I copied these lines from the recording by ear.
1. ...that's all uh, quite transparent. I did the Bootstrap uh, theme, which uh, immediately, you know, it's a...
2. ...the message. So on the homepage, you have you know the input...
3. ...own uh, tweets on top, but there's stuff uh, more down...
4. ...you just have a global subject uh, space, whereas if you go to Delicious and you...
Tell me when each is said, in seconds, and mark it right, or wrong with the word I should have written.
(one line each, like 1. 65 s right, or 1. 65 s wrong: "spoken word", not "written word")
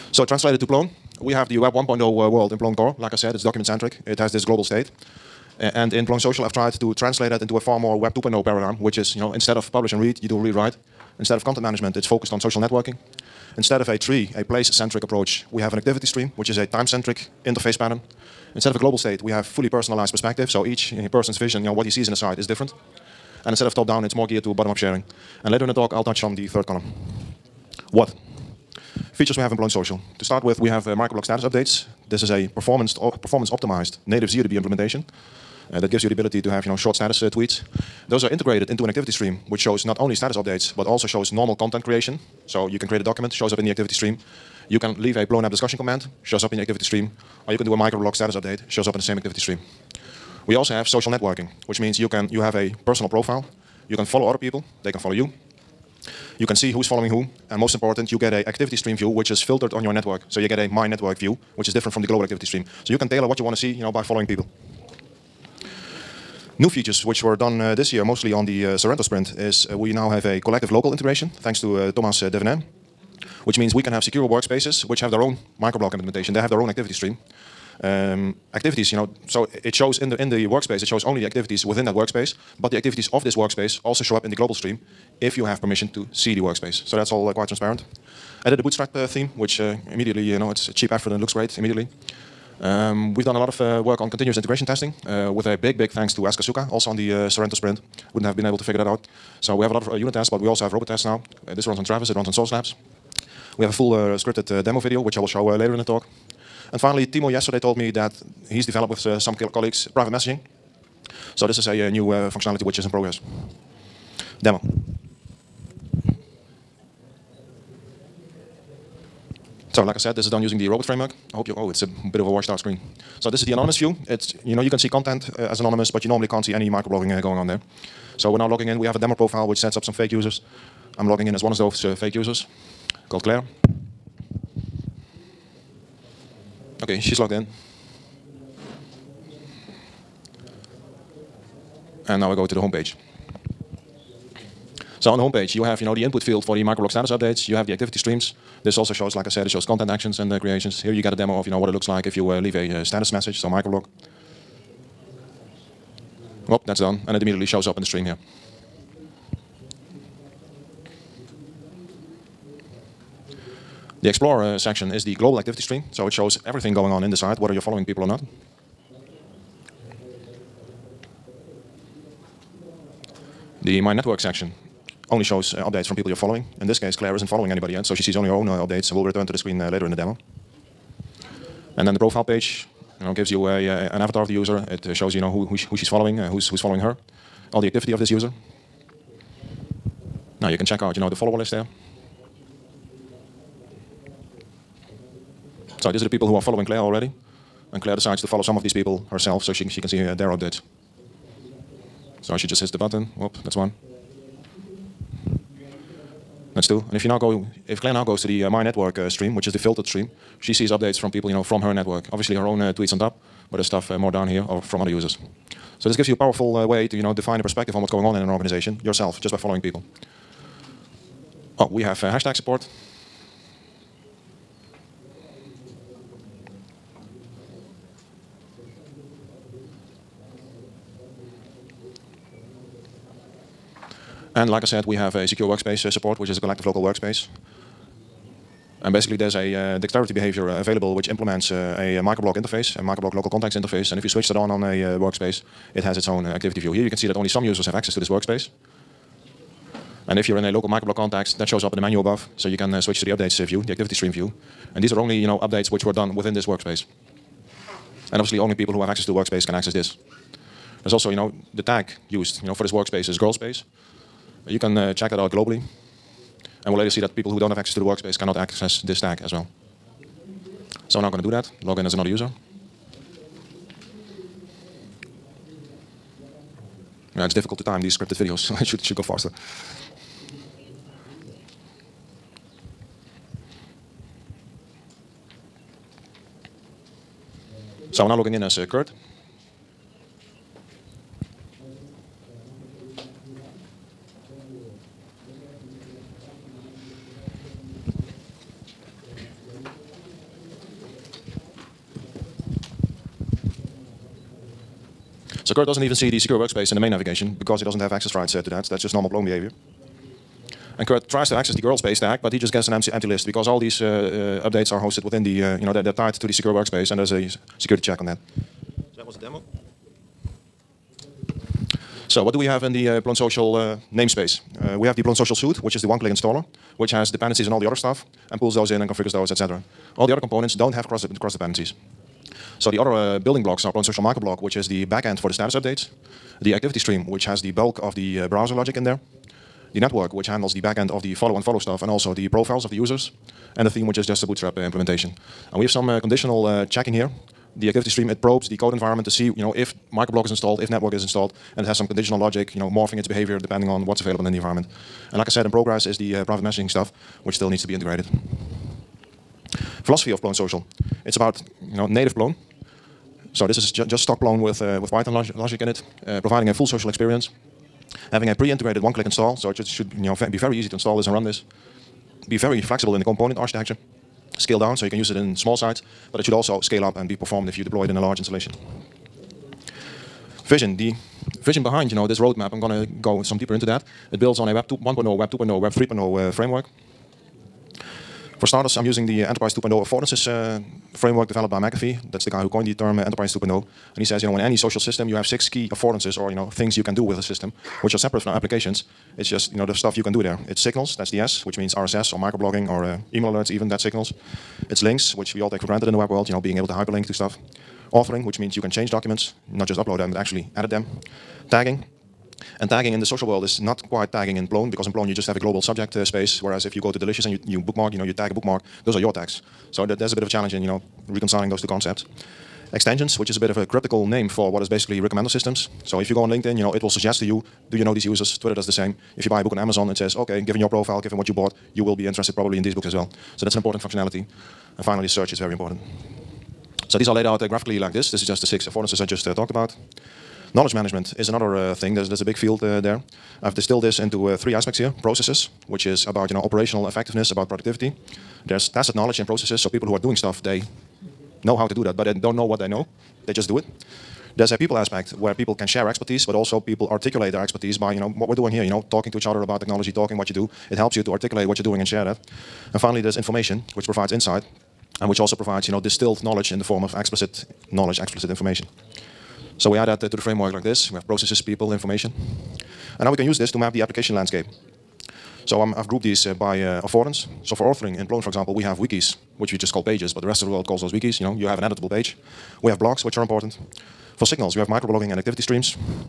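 1. 86 s right
2. 142 s wrong: "homepage", not "message"
3. 212 s right
4. 415 s right.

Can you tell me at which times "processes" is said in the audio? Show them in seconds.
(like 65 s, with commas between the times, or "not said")
445 s, 449 s, 471 s.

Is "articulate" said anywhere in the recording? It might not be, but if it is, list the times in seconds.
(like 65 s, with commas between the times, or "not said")
456 s, 461 s.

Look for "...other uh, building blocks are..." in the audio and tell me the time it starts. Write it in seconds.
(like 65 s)
332 s.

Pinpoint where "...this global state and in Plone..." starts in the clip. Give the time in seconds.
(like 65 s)
4 s.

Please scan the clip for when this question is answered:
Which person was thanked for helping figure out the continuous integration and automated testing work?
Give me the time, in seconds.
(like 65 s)
96 s.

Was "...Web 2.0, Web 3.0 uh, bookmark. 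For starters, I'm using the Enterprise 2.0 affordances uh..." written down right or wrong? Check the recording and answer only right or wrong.
wrong.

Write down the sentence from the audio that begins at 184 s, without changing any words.
It uh, shows you know who who, sh who she's following, uh, who's who's following her, all the activity of this user.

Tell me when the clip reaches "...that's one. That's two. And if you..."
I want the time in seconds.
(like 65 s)
203 s.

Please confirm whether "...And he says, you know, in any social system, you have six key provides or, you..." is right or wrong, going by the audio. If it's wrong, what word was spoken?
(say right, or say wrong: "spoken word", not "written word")
wrong: "affordances", not "provides".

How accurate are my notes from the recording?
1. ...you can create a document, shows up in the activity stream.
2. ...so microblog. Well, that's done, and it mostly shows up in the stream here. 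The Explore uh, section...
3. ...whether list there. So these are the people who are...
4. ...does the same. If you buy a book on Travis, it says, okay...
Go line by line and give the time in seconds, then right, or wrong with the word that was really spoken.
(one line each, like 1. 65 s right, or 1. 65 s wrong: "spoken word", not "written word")
1. 42 s right
2. 153 s wrong: "immediately", not "mostly"
3. 191 s wrong: "follower", not "whether"
4. 428 s wrong: "Amazon", not "Travis".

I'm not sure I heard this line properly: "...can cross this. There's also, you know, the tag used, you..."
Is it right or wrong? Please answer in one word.
wrong.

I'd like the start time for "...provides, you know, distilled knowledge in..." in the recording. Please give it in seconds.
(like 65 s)
465 s.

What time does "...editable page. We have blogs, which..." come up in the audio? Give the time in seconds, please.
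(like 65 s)
481 s.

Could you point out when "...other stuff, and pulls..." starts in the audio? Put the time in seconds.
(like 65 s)
327 s.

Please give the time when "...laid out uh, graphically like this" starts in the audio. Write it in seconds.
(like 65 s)
437 s.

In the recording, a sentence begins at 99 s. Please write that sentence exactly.
So we have a lot of uh, unit tests, but we also have robot tests now.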